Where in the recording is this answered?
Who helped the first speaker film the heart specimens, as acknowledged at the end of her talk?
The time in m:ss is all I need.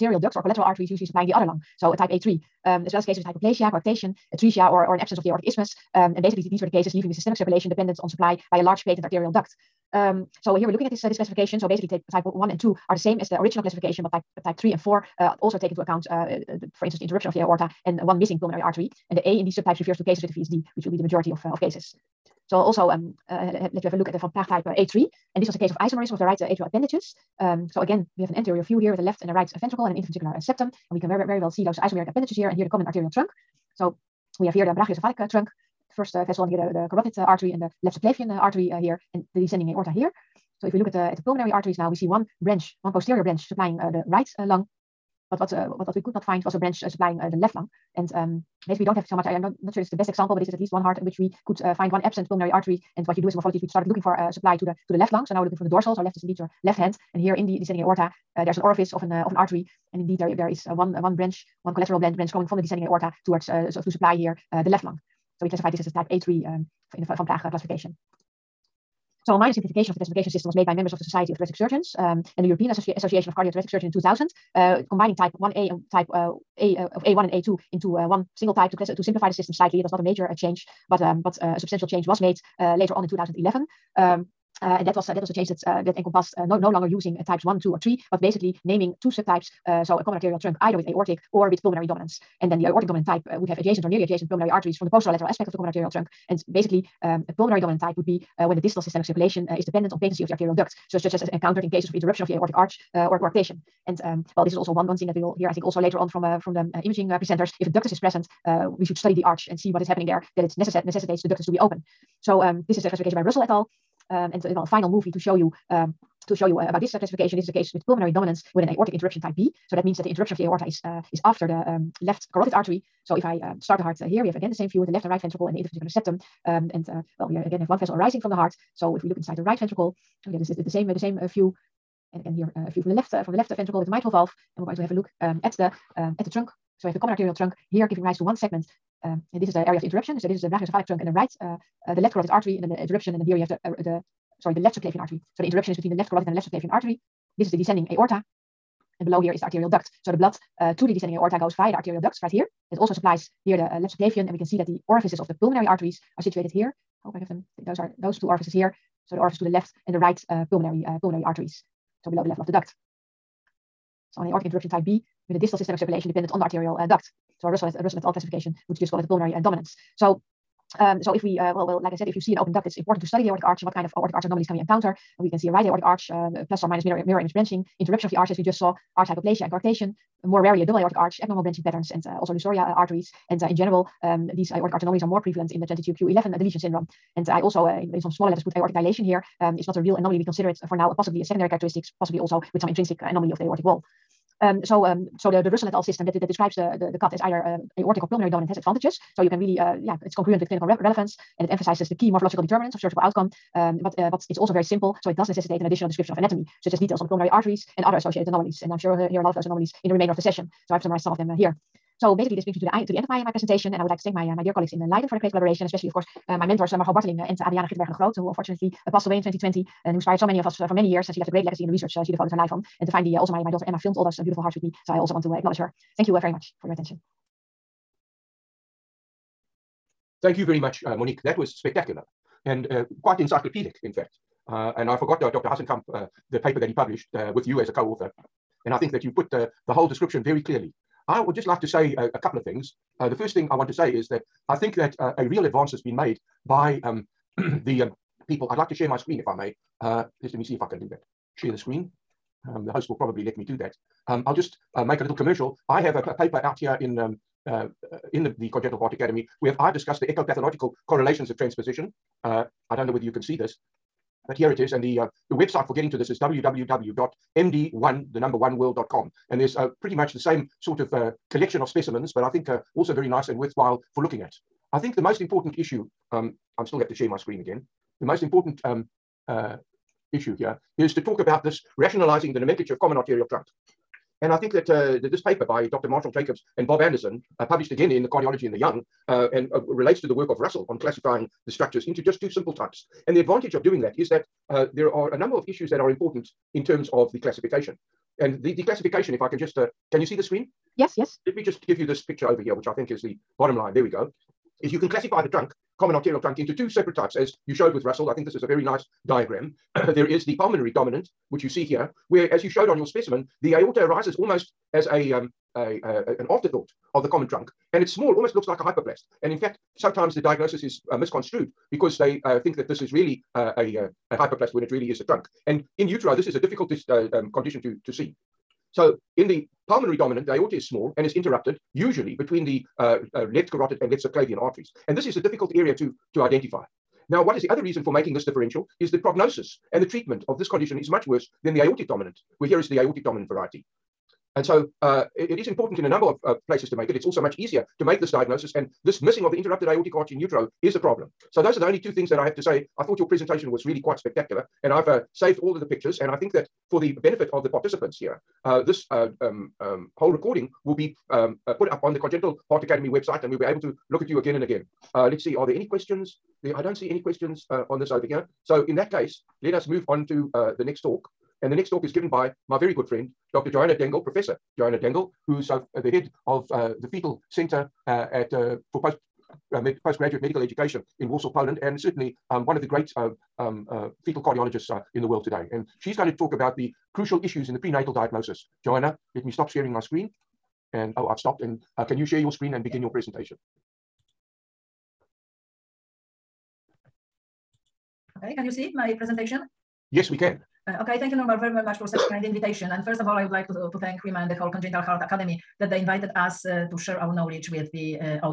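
3:43.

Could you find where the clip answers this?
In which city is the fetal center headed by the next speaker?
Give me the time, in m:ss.
6:21.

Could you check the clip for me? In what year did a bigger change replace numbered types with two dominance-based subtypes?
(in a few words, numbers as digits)
2011.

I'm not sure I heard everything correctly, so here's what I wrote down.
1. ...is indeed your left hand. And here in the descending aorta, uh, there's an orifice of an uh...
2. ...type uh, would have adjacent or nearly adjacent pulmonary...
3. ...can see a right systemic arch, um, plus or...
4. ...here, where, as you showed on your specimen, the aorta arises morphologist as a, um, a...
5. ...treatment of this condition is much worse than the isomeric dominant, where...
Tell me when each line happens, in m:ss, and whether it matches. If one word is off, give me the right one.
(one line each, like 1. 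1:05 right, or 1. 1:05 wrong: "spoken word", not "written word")
1. 0:56 right
2. 1:33 right
3. 2:55 wrong: "aortic", not "systemic"
4. 5:11 wrong: "almost", not "morphologist"
5. 5:39 wrong: "aortic", not "isomeric".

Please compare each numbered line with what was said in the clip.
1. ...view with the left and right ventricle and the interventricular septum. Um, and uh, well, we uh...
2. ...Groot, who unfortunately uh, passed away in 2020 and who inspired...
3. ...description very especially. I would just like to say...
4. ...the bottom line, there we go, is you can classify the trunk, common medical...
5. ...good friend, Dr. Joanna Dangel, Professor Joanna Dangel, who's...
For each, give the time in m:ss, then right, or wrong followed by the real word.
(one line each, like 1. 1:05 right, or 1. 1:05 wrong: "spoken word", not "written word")
1. 2:04 right
2. 3:37 right
3. 3:59 wrong: "clearly", not "especially"
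4. 5:03 wrong: "arterial", not "medical"
5. 6:12 right.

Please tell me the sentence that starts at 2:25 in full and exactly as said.
So the interruption is between the left carotid and the left subclavian artery.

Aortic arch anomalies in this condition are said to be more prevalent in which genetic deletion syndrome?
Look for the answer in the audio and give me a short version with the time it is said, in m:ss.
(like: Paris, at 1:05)
22q11 deletion syndrome, at 3:05.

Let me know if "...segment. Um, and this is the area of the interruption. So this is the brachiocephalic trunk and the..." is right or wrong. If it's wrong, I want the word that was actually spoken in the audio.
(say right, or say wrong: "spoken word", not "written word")
right.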